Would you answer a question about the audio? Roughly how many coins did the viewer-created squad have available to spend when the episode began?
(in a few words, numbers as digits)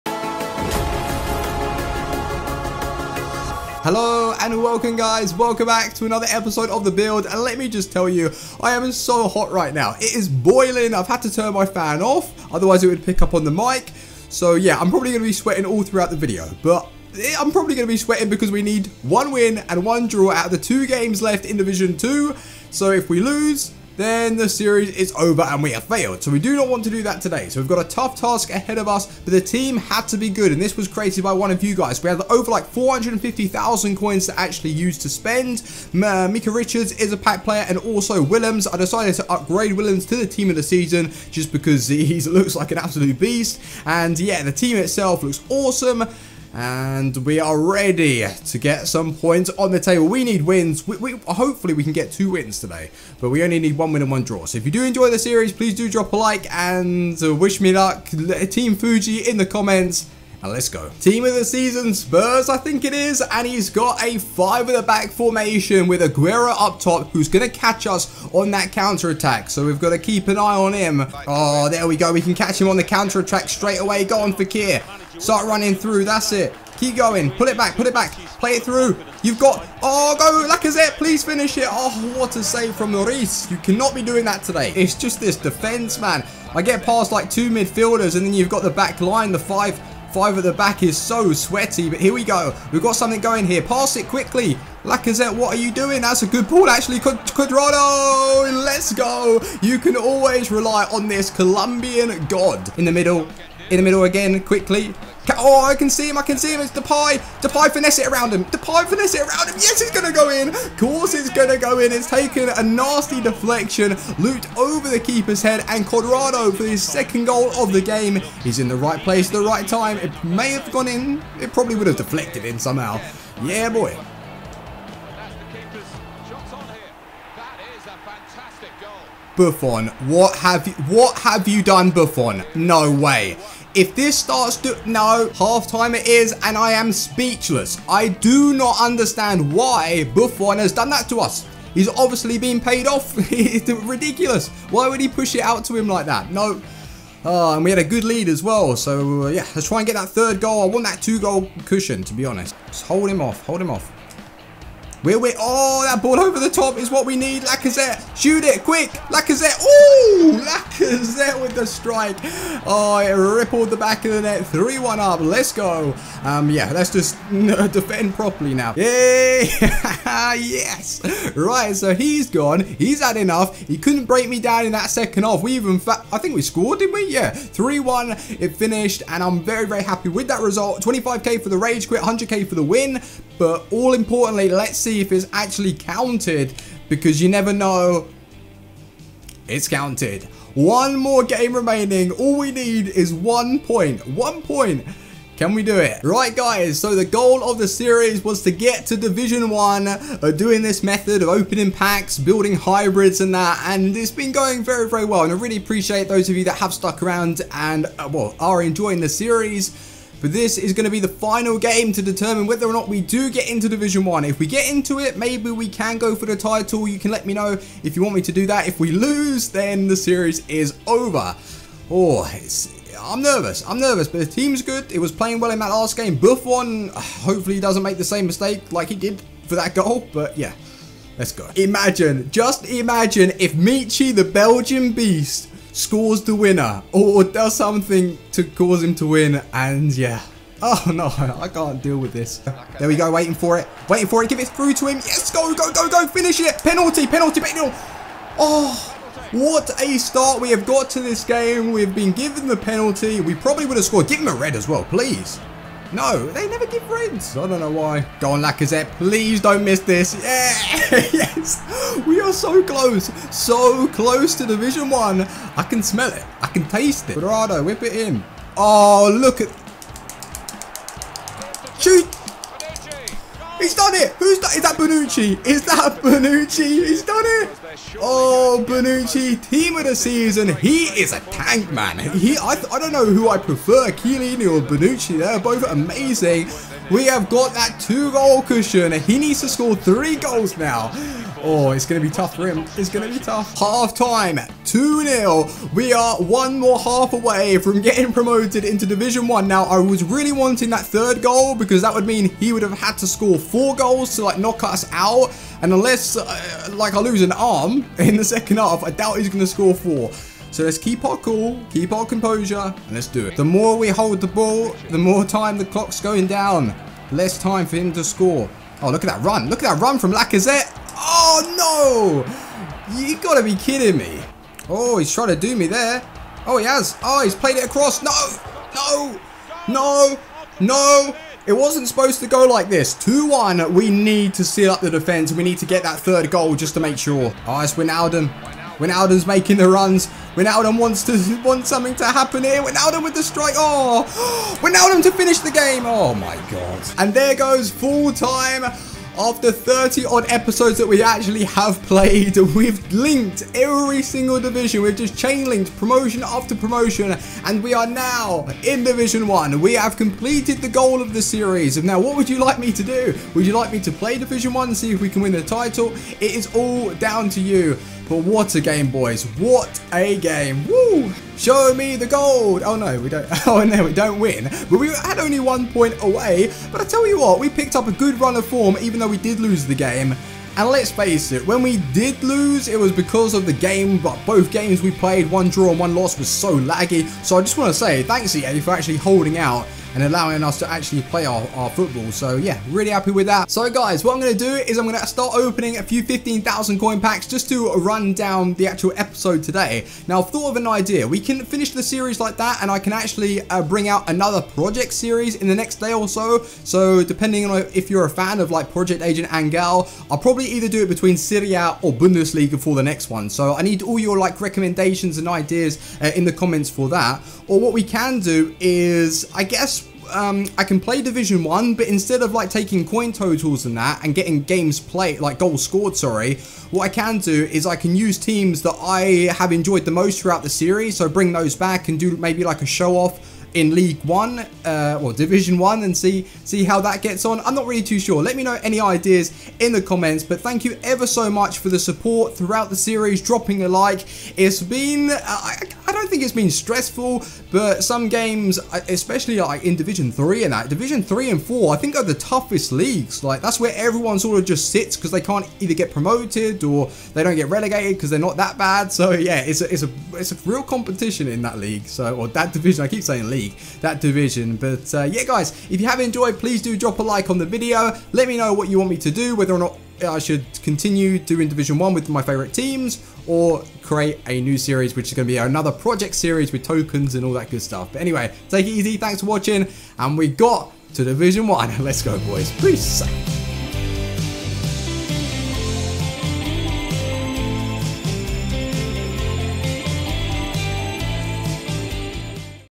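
450,000.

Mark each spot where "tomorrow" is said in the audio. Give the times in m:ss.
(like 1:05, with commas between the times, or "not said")
not said.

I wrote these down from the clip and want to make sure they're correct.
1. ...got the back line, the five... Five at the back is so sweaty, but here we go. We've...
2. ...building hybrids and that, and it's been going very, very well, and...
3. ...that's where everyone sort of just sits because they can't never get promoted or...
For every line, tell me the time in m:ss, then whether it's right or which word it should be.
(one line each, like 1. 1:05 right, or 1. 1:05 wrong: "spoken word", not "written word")
1. 1:28 right
2. 3:22 right
3. 7:33 wrong: "either", not "never".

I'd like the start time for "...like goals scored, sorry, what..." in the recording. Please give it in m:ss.
7:05.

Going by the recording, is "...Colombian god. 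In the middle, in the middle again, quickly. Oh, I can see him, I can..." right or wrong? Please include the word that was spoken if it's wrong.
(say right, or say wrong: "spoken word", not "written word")
right.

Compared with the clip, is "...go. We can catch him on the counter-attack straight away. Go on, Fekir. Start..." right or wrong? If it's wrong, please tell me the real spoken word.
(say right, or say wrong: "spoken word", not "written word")
right.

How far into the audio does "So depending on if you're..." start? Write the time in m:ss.
6:46.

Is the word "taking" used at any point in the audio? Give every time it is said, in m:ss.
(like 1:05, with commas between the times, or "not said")
7:02.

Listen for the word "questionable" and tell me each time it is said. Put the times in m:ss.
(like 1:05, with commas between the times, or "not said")
not said.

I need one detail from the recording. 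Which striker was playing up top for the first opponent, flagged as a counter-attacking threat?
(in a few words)
Aguero.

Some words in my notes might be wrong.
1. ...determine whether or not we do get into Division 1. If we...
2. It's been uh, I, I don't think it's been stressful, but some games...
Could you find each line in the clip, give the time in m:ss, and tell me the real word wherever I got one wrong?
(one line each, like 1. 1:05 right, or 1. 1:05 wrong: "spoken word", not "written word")
1. 3:32 right
2. 7:24 right.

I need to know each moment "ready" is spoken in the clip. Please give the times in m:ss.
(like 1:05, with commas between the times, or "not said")
0:47.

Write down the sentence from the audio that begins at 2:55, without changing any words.
We even, I think we scored, did not we?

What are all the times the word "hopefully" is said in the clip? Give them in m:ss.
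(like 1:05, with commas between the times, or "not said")
0:51, 3:46.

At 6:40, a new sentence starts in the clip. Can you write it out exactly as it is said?
Now, I've thought of an idea.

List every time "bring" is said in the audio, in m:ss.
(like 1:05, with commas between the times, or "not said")
6:43, 7:11.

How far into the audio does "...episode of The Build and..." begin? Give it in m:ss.
0:06.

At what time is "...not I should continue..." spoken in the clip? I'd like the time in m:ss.
7:49.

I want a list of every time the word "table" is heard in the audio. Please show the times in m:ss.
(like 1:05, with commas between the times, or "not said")
0:49.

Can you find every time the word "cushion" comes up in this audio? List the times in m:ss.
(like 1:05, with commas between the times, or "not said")
2:31, 4:48.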